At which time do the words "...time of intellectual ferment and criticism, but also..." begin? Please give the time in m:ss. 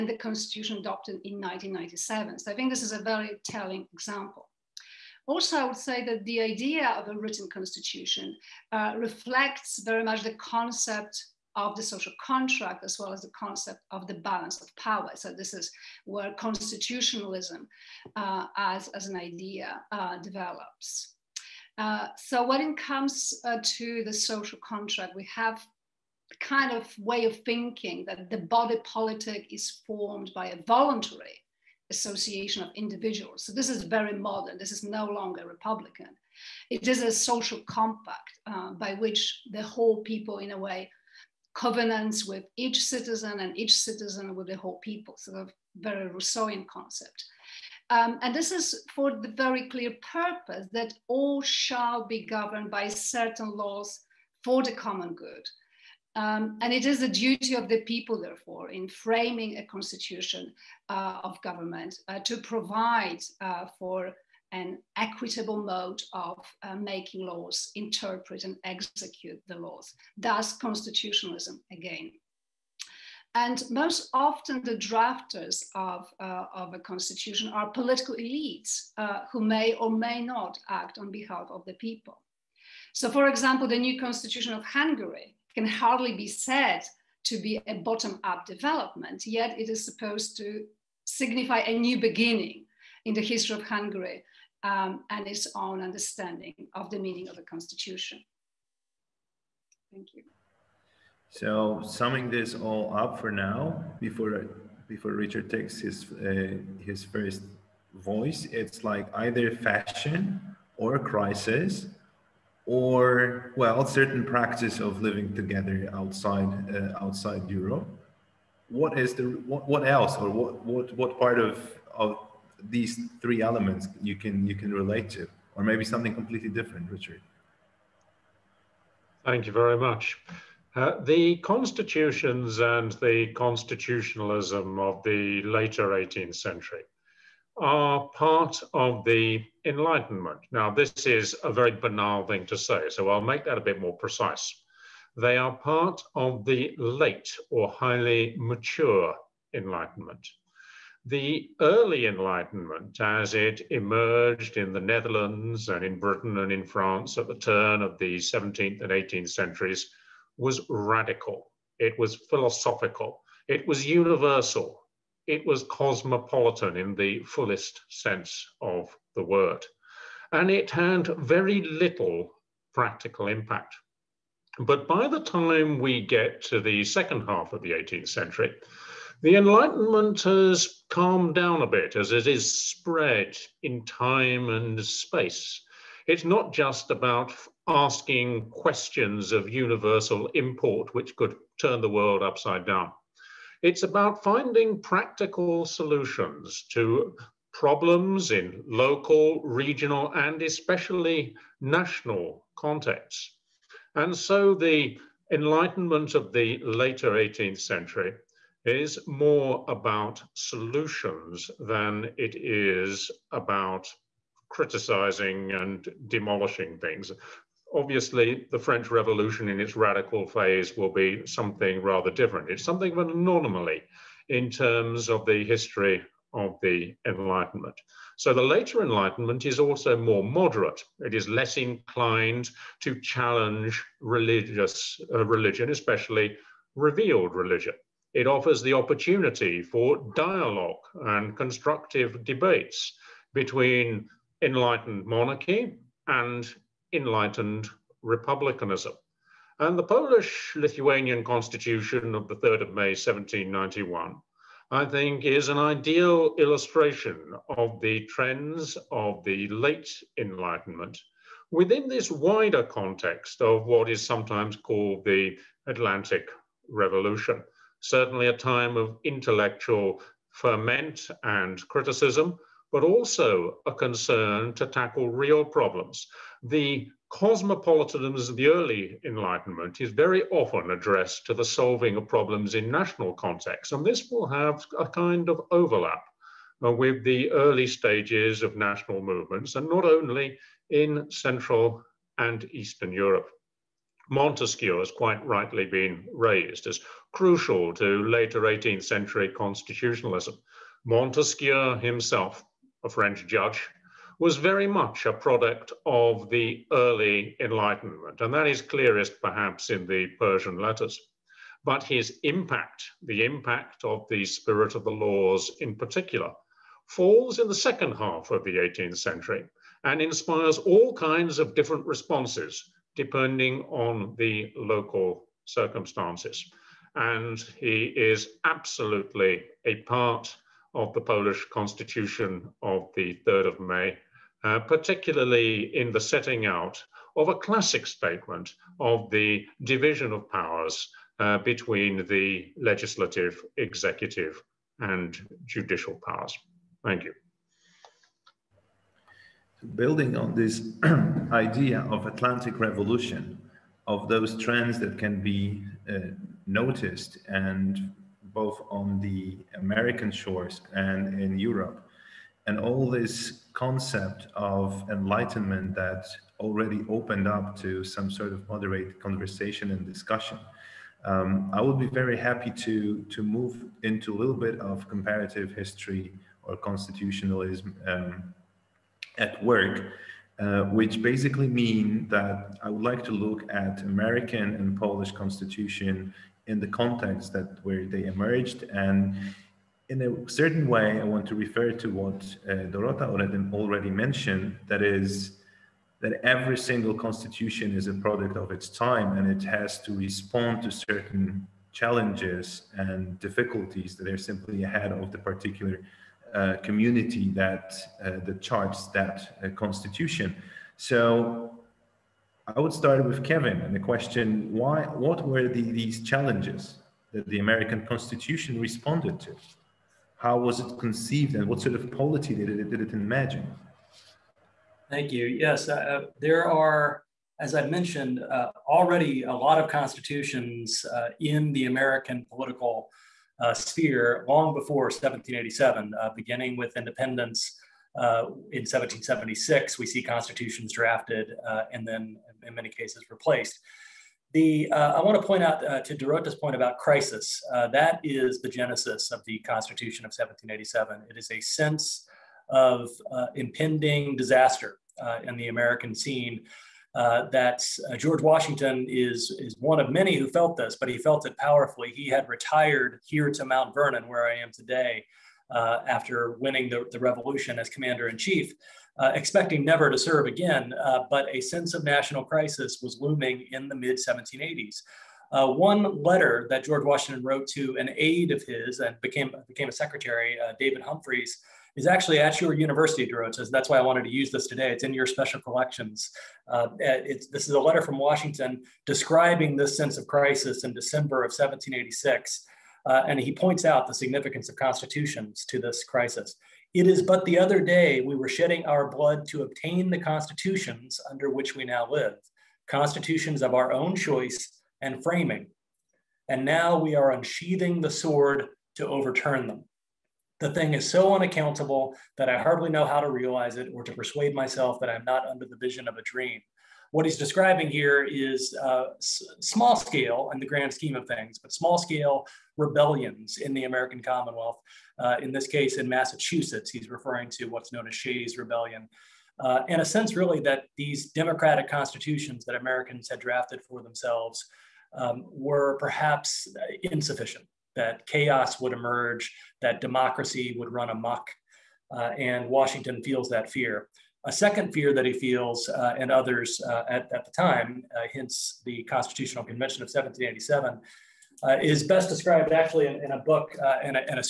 4:28.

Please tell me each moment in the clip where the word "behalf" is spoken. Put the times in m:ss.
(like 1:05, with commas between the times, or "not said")
1:21.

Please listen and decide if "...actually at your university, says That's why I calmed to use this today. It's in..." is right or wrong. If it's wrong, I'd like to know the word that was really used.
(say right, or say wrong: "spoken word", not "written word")
wrong: "wanted", not "calmed".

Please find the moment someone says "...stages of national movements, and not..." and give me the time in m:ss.
4:47.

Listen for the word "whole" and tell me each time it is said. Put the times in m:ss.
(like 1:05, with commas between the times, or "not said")
0:39, 0:44.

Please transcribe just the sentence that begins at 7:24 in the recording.
The, uh, I want to point out uh, to Dorota's point about crisis.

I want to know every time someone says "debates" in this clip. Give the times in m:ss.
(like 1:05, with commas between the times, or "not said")
4:02.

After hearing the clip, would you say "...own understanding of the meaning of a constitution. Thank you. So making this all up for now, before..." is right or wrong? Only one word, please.
wrong.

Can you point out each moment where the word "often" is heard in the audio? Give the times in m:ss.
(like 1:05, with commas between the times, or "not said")
1:14, 4:40.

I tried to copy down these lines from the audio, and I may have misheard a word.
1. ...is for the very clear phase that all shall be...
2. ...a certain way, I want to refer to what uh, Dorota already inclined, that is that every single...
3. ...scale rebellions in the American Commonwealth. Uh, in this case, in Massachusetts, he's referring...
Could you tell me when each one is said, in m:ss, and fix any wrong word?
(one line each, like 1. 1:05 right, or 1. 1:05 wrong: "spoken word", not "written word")
1. 0:48 wrong: "purpose", not "phase"
2. 6:30 wrong: "mentioned", not "inclined"
3. 8:41 right.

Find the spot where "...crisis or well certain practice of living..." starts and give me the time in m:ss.
1:50.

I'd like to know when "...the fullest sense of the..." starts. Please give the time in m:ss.
2:46.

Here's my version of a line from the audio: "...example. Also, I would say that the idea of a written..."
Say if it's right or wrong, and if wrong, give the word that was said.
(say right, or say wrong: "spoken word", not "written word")
right.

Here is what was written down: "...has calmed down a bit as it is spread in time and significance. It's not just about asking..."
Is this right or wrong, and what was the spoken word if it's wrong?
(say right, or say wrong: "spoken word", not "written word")
wrong: "space", not "significance".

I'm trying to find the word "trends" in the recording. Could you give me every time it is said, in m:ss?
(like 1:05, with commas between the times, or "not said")
4:18, 5:54.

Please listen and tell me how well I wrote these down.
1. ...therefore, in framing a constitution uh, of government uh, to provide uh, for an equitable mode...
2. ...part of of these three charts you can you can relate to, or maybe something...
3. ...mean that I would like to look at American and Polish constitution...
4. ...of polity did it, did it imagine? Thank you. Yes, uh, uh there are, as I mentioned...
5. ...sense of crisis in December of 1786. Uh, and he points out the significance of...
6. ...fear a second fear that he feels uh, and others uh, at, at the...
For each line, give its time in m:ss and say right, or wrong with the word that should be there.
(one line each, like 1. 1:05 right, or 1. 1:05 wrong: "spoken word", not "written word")
1. 0:58 right
2. 2:01 wrong: "elements", not "charts"
3. 6:21 right
4. 7:01 right
5. 8:09 right
6. 9:03 right.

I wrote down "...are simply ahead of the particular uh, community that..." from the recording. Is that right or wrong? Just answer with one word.
right.